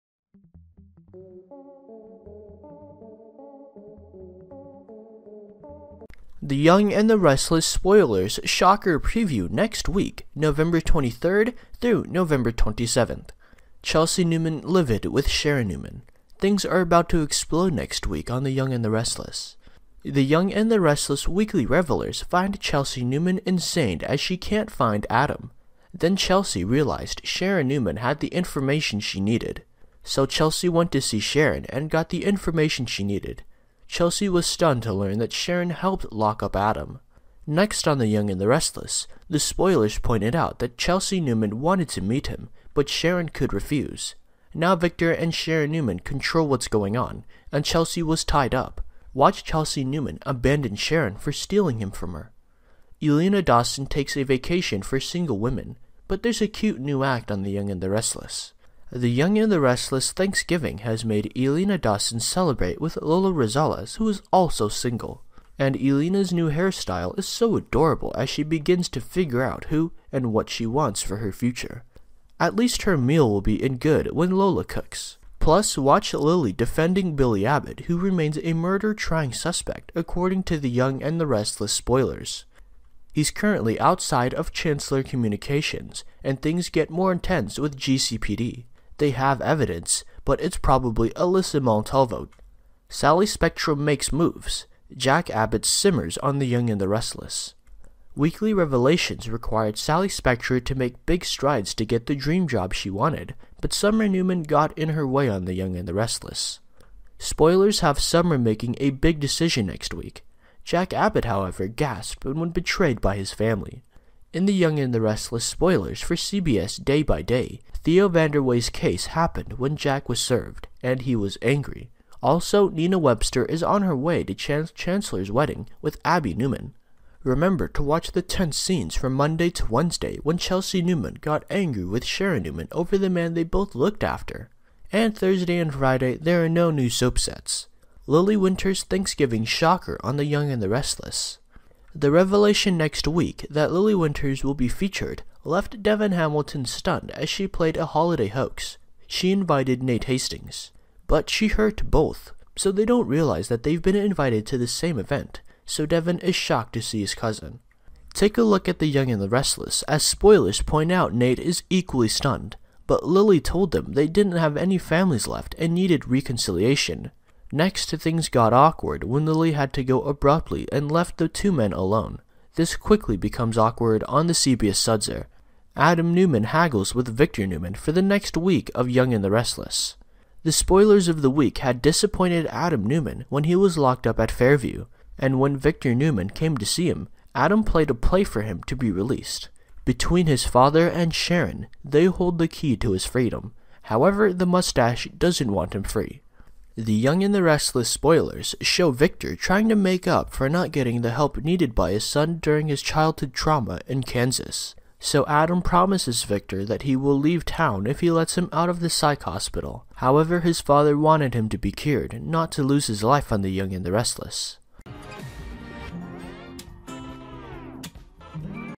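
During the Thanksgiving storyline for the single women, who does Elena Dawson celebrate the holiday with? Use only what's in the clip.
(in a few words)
Lola Rosales.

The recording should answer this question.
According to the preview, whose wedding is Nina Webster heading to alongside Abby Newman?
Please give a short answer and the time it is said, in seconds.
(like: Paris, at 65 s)
Chance Chancellor, at 124 s.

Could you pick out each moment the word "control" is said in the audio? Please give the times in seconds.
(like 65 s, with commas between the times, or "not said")
45 s.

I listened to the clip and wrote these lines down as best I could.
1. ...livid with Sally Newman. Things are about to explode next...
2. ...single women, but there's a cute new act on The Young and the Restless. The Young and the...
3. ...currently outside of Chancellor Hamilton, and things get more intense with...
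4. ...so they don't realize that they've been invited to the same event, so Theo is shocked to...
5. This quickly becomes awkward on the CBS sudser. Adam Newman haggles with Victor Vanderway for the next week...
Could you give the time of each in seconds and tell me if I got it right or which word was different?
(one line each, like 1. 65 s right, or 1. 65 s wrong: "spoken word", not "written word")
1. 14 s wrong: "Sharon", not "Sally"
2. 54 s right
3. 83 s wrong: "Communications", not "Hamilton"
4. 152 s wrong: "Devon", not "Theo"
5. 172 s wrong: "Newman", not "Vanderway".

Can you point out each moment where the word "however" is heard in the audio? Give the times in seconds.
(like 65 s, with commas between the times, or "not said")
111 s, 193 s, 209 s.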